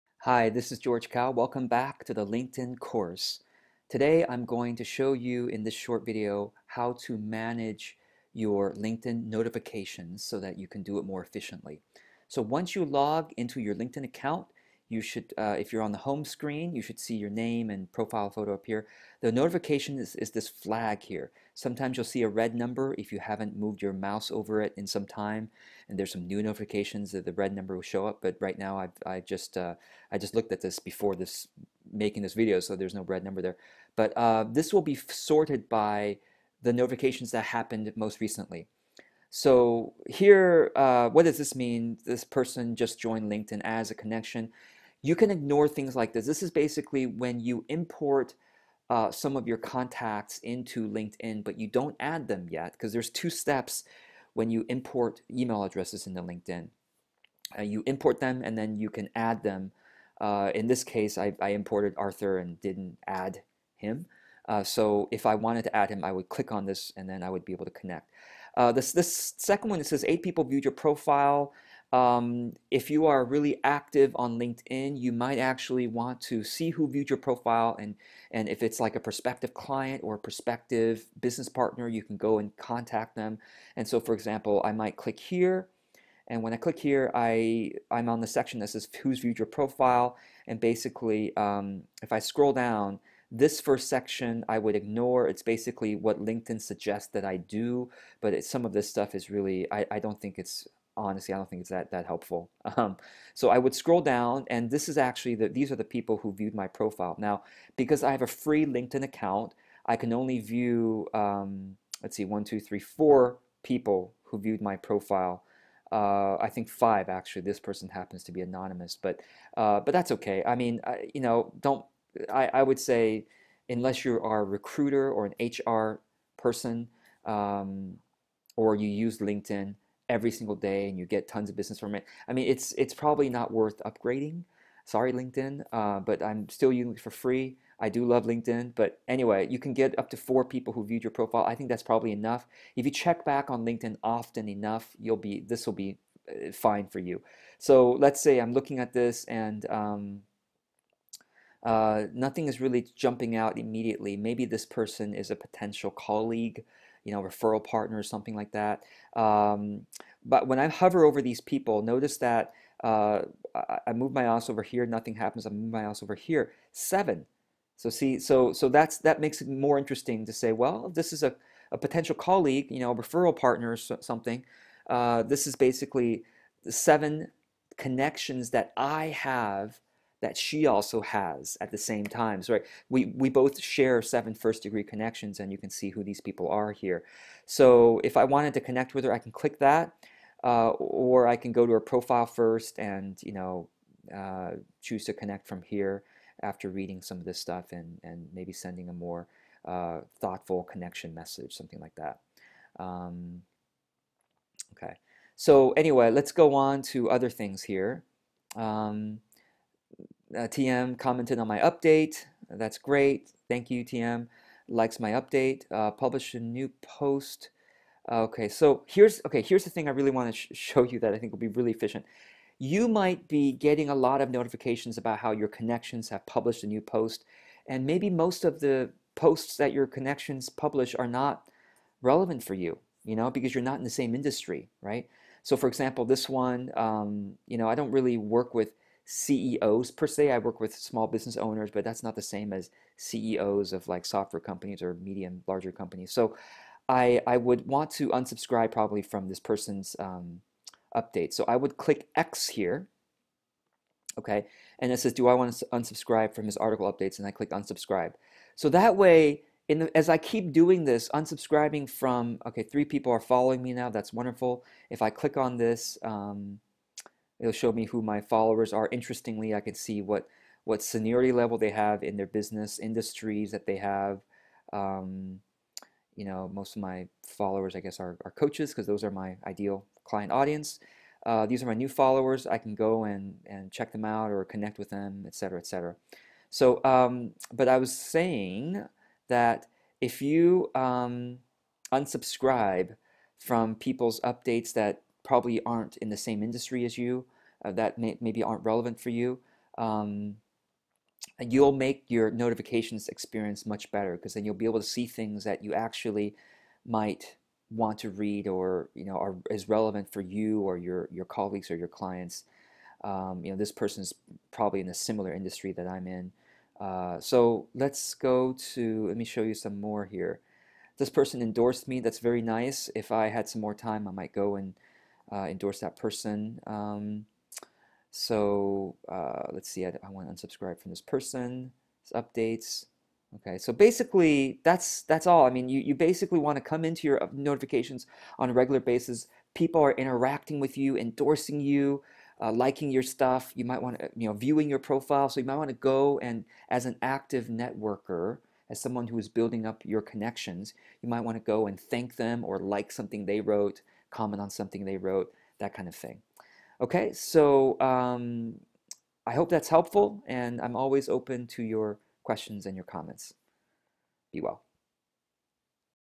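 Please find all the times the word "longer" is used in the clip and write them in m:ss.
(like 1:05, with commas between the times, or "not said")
not said.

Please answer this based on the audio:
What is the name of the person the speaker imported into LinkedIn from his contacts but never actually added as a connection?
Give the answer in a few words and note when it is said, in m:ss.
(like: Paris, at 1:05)
Arthur, at 1:01.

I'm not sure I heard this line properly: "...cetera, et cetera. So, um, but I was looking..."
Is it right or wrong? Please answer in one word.
wrong.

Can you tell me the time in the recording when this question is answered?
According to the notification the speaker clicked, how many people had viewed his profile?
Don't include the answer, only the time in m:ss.
1:10.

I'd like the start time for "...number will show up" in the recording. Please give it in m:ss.
0:27.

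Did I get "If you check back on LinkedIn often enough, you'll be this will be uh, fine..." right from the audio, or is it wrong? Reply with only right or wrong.
right.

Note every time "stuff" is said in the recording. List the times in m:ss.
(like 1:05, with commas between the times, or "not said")
1:38, 3:17, 5:43.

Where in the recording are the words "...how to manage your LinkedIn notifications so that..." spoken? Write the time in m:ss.
0:06.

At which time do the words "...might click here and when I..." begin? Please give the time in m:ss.
1:24.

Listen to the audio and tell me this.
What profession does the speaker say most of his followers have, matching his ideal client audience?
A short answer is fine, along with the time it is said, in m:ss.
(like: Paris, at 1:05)
Coaches, at 4:38.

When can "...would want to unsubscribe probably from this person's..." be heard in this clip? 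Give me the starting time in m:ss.
4:07.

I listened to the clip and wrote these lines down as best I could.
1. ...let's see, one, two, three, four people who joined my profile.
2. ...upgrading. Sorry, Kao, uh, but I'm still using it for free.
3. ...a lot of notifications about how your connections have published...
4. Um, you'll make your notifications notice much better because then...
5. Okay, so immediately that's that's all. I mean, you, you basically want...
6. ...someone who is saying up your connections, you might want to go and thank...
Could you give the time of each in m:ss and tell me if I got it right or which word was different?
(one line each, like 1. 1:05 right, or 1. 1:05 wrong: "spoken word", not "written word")
1. 1:52 wrong: "viewed", not "joined"
2. 2:13 wrong: "LinkedIn", not "Kao"
3. 3:43 right
4. 4:59 wrong: "experience", not "notice"
5. 5:33 wrong: "basically", not "immediately"
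6. 5:48 wrong: "building", not "saying".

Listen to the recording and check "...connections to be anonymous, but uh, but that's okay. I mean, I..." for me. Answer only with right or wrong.
wrong.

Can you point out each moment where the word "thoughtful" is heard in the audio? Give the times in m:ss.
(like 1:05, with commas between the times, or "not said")
3:20.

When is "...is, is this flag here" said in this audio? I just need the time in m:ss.
0:19.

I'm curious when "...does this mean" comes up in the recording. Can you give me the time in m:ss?
0:41.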